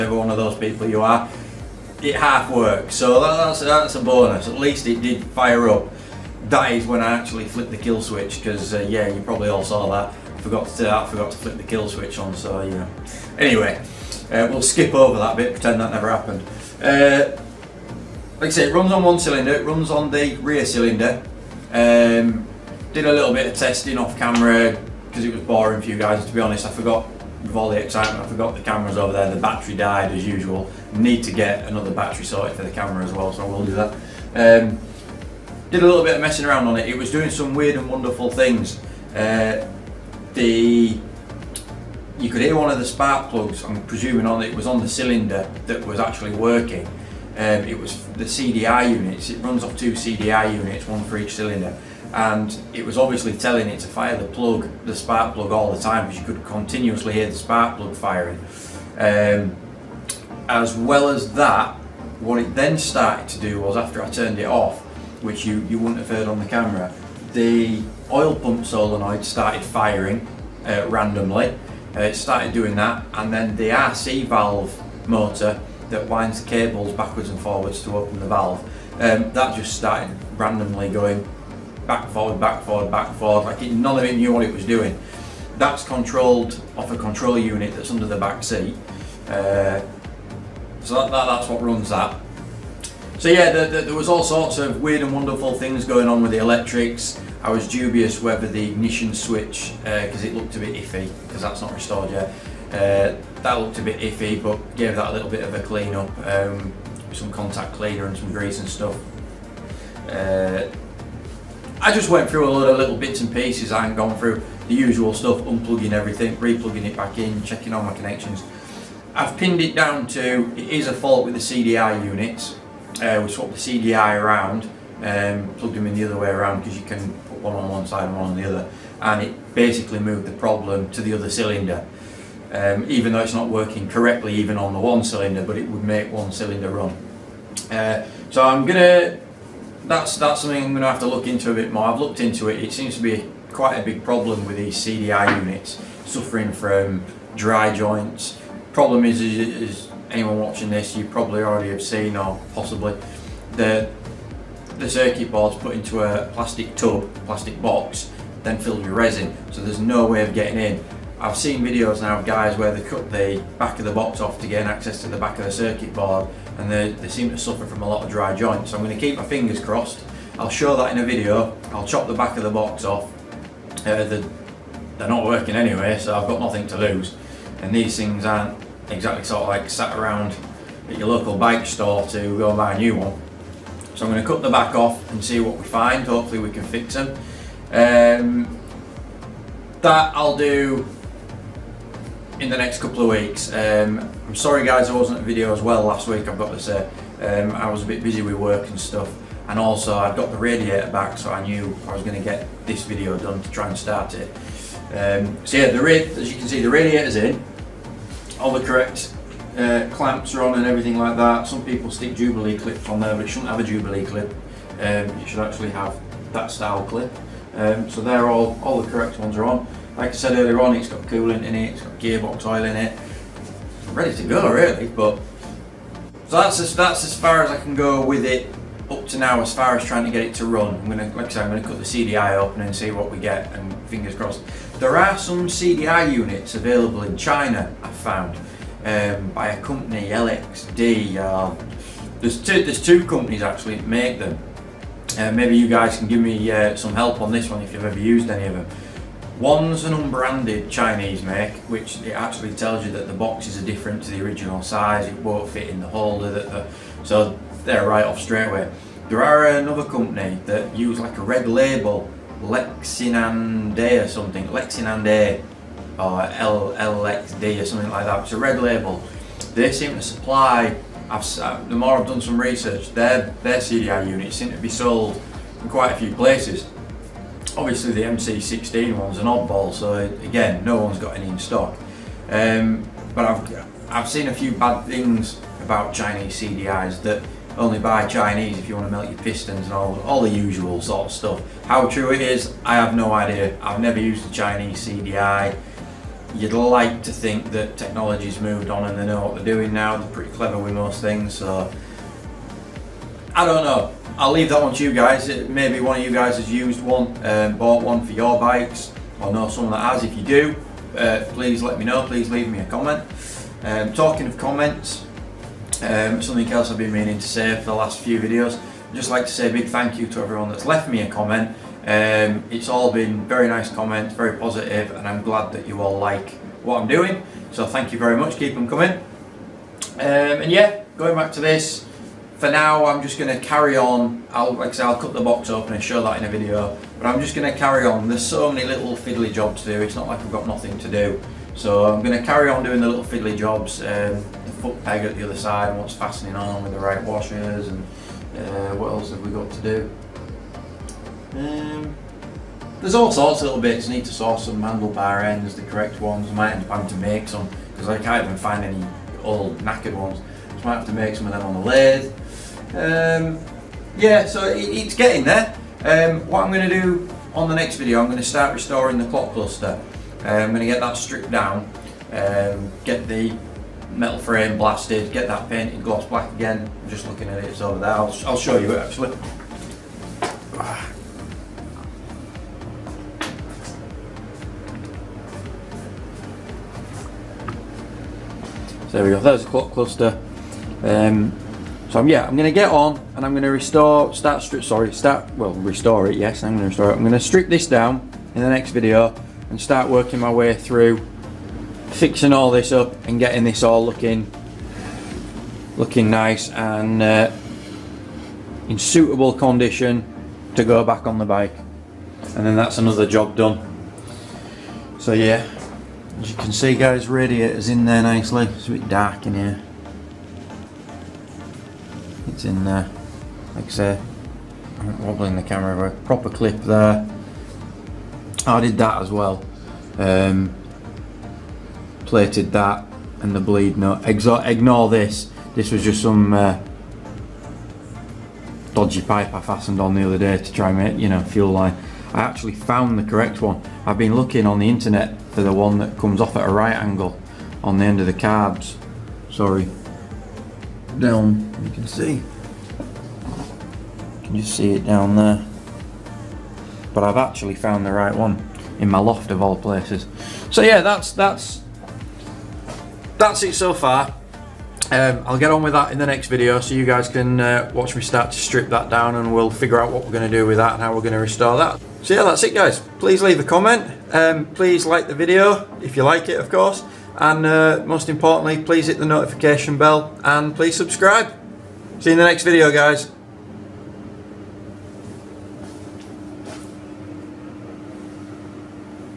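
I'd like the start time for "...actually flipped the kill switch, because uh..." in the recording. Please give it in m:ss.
0:07.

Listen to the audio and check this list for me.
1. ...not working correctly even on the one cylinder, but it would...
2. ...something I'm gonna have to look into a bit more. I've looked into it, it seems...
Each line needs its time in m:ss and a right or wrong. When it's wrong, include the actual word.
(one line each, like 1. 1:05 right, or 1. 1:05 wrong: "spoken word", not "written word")
1. 2:13 right
2. 2:20 right.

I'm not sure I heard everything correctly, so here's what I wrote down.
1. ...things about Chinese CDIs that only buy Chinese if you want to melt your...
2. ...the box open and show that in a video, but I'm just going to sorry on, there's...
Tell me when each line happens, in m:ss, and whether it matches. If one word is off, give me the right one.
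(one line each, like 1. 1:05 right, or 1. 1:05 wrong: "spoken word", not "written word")
1. 4:44 right
2. 5:35 wrong: "carry", not "sorry".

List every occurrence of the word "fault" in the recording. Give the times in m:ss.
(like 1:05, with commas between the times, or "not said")
2:00.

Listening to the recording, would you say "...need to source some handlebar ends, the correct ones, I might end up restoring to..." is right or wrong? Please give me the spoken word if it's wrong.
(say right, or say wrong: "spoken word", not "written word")
wrong: "having", not "restoring".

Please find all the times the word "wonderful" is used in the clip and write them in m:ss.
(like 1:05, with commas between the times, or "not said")
0:37, 1:35.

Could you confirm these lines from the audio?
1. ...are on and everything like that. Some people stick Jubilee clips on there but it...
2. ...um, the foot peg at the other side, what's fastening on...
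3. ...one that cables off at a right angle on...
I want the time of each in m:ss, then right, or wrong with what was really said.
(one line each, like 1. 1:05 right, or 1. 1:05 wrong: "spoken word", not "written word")
1. 3:30 right
2. 5:43 right
3. 7:25 wrong: "comes", not "cables".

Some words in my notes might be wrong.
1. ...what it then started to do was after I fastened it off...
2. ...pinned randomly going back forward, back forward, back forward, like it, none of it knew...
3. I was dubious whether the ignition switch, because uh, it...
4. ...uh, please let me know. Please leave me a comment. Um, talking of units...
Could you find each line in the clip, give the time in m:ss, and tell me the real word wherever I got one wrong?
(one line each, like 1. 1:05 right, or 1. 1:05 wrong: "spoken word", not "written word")
1. 1:02 wrong: "turned", not "fastened"
2. 1:19 wrong: "started", not "pinned"
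3. 1:37 right
4. 5:10 wrong: "comments", not "units".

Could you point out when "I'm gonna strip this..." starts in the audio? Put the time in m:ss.
6:36.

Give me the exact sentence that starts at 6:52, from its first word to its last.
And then that's another job done.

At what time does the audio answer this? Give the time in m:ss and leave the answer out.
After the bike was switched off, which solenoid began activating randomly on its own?
1:08.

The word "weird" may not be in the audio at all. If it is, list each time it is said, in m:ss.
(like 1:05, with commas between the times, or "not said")
0:37, 1:34.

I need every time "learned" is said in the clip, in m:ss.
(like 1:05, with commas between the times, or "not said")
not said.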